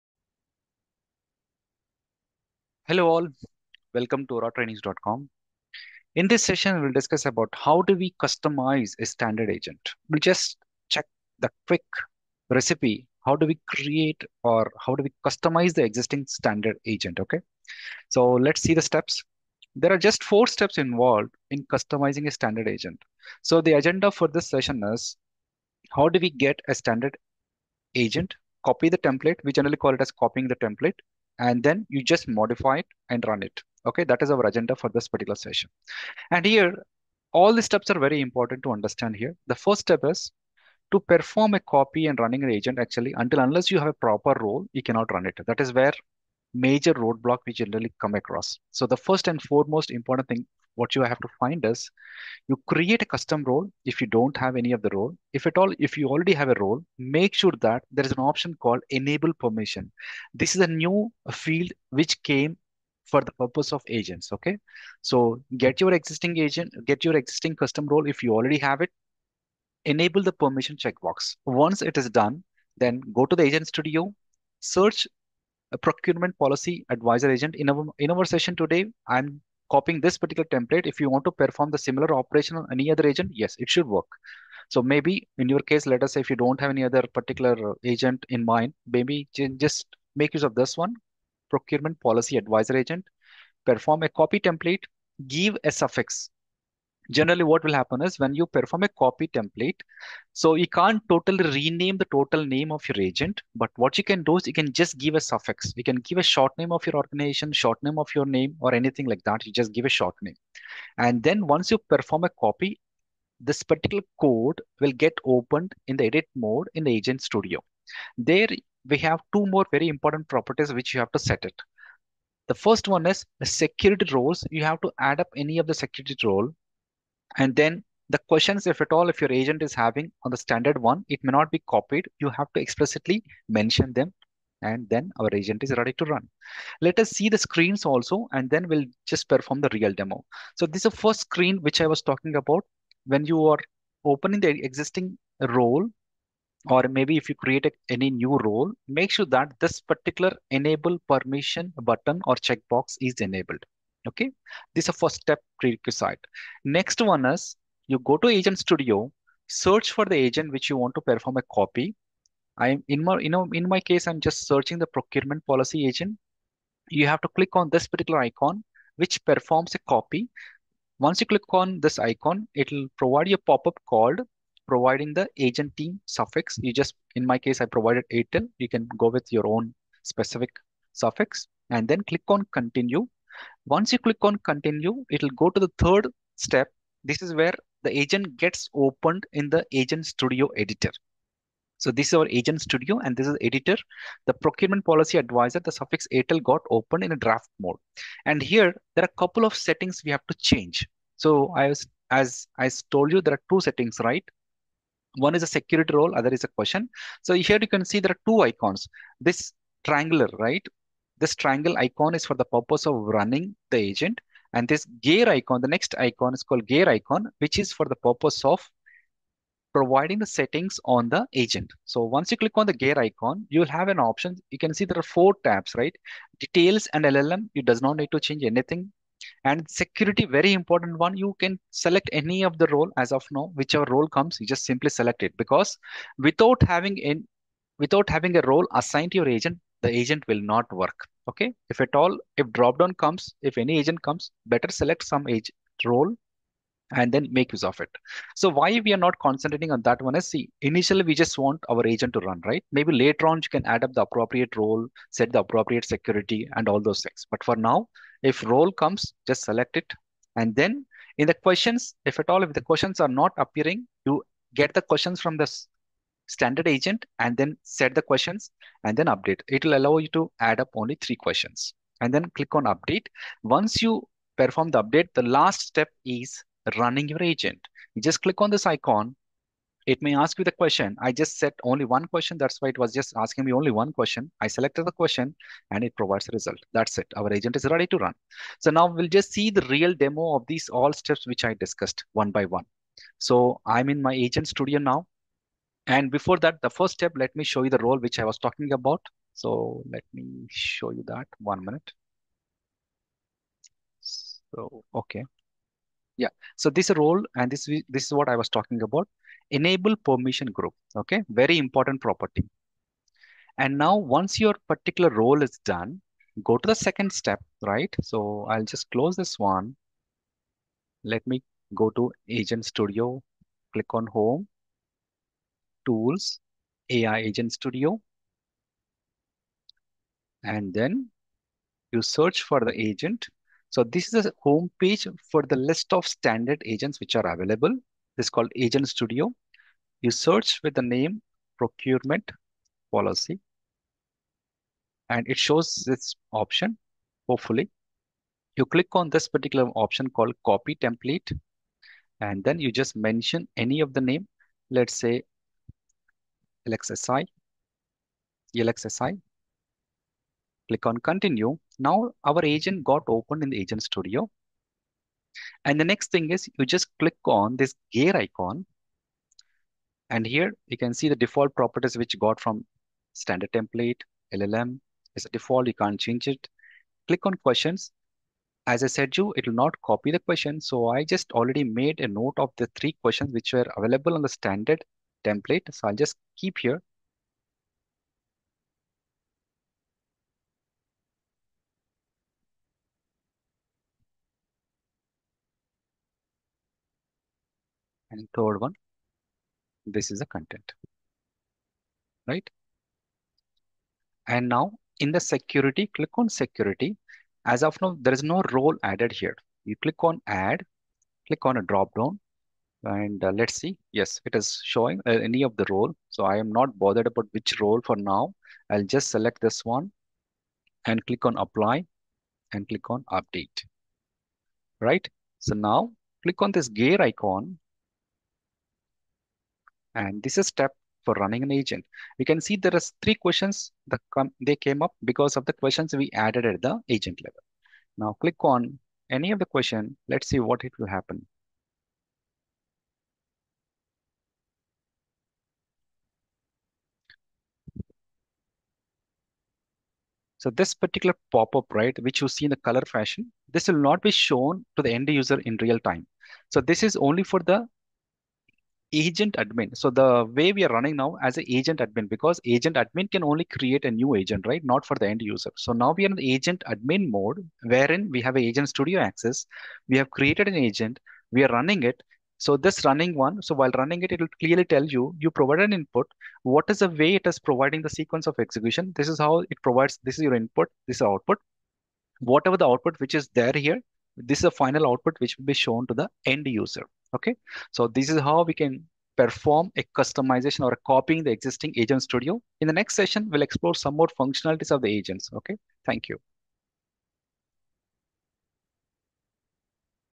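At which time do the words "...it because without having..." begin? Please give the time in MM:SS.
03:55.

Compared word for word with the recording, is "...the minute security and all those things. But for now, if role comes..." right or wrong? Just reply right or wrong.
wrong.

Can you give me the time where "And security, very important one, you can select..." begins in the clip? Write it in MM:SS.
03:49.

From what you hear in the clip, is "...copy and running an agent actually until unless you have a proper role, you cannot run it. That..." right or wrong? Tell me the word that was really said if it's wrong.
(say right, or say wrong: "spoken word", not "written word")
right.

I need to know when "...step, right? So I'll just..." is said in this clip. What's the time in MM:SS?
05:17.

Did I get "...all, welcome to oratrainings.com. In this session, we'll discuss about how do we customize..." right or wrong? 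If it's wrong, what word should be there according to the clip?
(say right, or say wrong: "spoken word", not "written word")
right.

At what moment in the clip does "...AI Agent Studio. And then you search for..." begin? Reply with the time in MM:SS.
05:26.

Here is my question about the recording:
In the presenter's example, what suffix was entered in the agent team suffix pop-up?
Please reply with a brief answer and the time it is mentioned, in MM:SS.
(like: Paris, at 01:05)
ATEL, at 02:58.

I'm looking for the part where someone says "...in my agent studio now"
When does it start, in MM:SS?
04:53.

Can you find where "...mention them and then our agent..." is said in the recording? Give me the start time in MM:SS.
02:13.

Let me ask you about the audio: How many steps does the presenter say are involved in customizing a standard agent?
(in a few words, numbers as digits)
4.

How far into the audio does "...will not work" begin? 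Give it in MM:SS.
04:00.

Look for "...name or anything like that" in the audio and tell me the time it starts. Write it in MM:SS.
01:48.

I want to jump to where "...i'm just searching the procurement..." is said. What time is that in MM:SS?
02:44.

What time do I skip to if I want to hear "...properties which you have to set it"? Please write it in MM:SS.
02:00.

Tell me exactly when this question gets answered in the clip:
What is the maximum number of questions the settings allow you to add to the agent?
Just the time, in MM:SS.
04:30.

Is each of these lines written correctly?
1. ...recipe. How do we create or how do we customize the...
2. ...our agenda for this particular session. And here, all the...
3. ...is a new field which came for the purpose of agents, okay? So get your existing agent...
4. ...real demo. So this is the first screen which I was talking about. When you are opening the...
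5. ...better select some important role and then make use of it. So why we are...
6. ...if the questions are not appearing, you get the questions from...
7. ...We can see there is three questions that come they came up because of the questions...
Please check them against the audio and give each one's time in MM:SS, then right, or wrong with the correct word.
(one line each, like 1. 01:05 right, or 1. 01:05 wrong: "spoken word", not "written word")
1. 00:12 right
2. 00:34 right
3. 01:00 right
4. 02:19 right
5. 04:04 wrong: "agent", not "important"
6. 04:22 right
7. 07:12 right.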